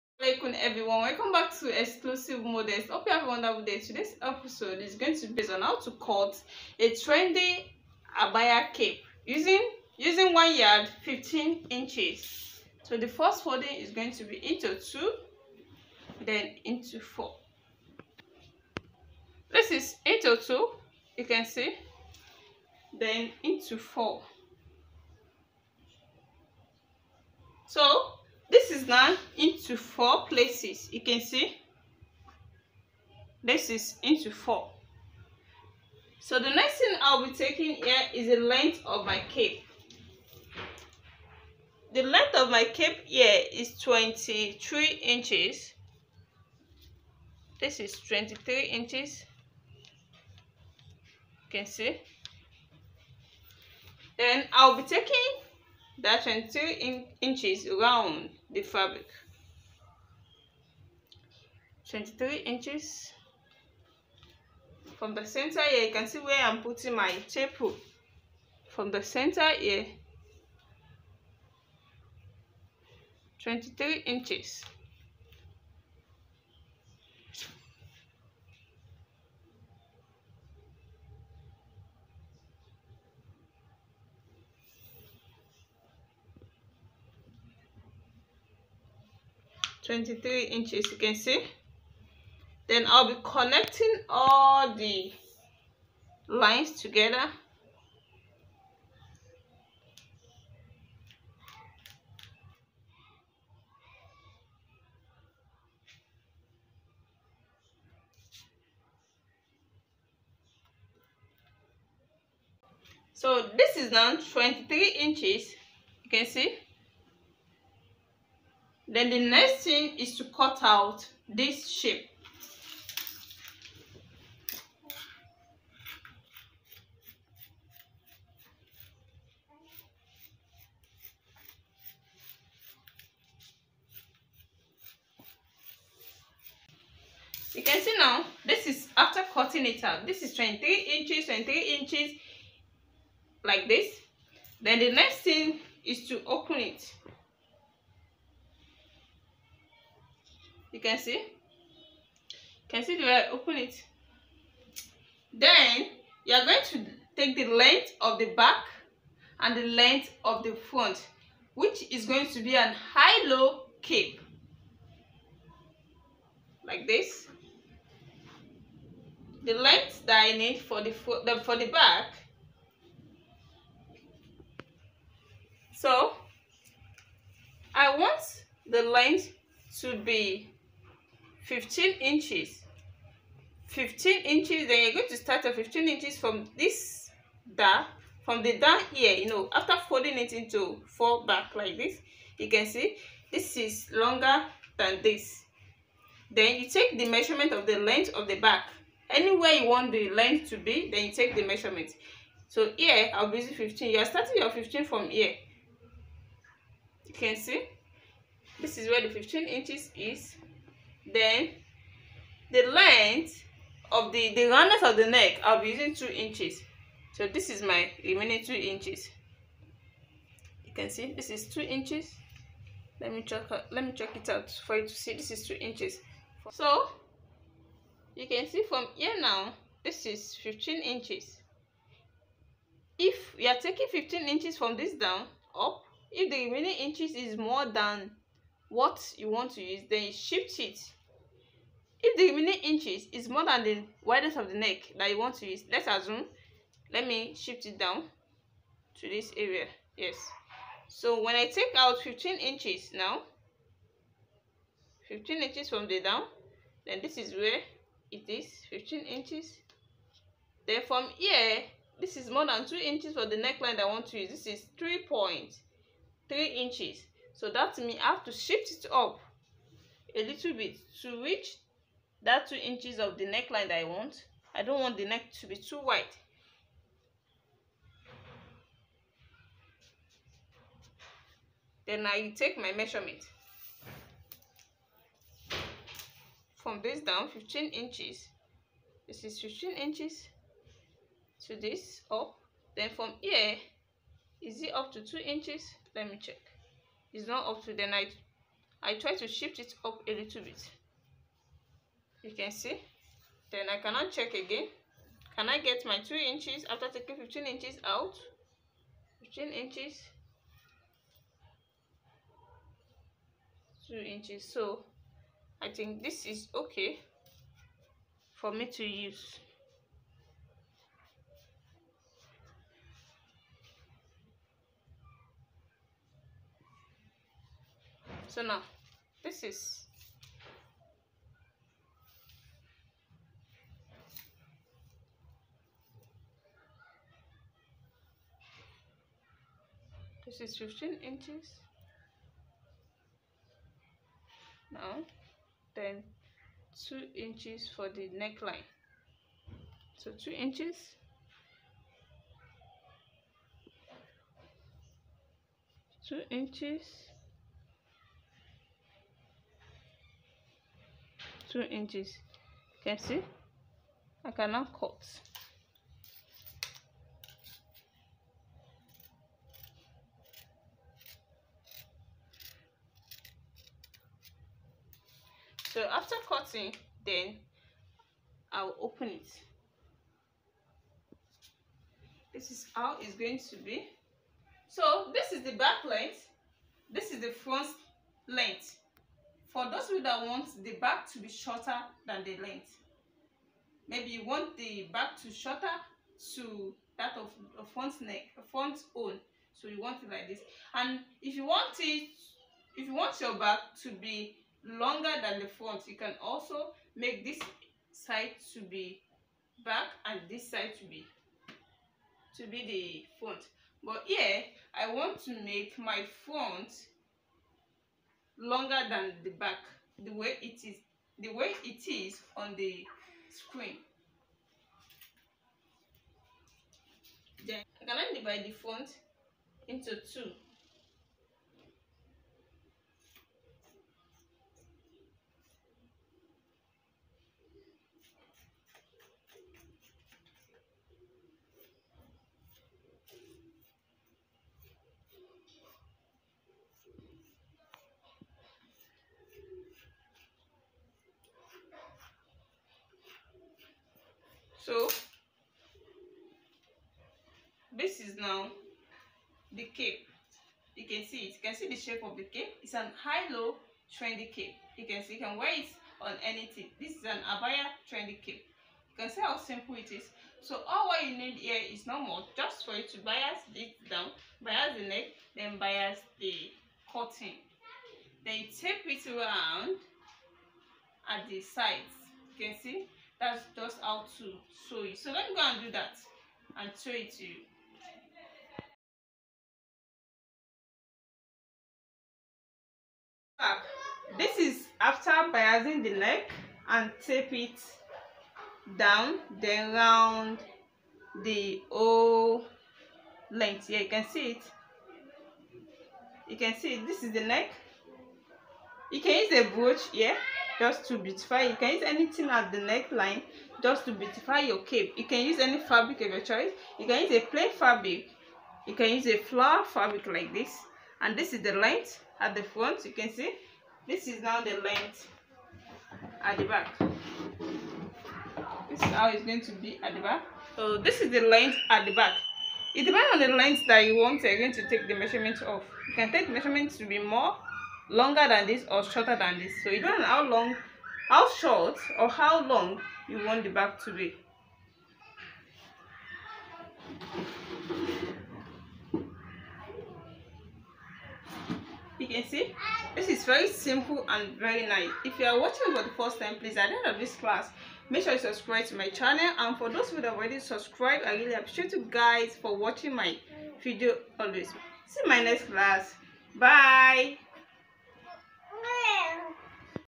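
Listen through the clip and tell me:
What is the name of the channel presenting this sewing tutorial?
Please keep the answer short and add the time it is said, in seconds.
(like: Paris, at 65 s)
Xclusive Modest, at 1 s.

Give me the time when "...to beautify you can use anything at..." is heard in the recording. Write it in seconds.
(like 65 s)
510 s.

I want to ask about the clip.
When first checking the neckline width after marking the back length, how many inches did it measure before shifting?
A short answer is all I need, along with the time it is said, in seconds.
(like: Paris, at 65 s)
3.3 inches, at 264 s.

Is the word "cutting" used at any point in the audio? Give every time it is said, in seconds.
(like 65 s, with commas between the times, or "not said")
139 s, 376 s, 476 s.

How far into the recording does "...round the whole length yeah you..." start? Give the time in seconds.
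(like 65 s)
499 s.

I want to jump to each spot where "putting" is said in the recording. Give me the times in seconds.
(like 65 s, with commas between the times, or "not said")
66 s.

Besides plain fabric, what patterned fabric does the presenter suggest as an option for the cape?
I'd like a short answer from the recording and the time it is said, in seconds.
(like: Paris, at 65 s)
Flower fabric, at 519 s.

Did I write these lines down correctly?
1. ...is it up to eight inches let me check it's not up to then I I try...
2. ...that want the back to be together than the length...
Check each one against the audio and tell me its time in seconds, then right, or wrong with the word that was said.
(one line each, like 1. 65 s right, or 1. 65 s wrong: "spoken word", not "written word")
1. 294 s wrong: "two", not "eight"
2. 390 s wrong: "shorter", not "together".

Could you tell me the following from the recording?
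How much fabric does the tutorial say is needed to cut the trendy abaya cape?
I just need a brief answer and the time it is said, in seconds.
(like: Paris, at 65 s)
1 yard 15 inches, at 10 s.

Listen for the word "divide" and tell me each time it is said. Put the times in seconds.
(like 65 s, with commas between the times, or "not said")
428 s.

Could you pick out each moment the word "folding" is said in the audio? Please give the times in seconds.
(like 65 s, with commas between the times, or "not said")
13 s, 189 s.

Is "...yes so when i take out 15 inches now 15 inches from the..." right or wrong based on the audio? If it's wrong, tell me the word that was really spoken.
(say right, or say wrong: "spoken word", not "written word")
right.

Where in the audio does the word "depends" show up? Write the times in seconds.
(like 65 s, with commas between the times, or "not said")
532 s, 539 s.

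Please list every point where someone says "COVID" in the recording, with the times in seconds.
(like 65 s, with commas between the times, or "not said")
not said.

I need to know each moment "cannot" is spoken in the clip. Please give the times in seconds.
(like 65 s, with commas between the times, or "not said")
303 s, 364 s.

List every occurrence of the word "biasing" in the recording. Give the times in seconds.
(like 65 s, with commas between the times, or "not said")
495 s.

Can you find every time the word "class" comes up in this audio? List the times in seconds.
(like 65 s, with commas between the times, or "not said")
557 s, 565 s.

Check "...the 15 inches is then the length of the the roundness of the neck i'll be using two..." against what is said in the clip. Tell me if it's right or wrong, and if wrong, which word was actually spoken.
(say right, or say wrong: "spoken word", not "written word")
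right.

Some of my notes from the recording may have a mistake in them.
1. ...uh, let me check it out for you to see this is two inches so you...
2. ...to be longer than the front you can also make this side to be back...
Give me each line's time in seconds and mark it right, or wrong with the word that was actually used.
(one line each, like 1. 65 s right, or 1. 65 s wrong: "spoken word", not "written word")
1. 223 s right
2. 403 s right.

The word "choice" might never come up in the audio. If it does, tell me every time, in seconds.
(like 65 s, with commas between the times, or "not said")
516 s.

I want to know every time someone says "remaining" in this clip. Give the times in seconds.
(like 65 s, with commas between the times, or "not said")
218 s, 236 s, 242 s.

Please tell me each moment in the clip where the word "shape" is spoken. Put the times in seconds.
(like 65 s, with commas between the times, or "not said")
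121 s, 461 s.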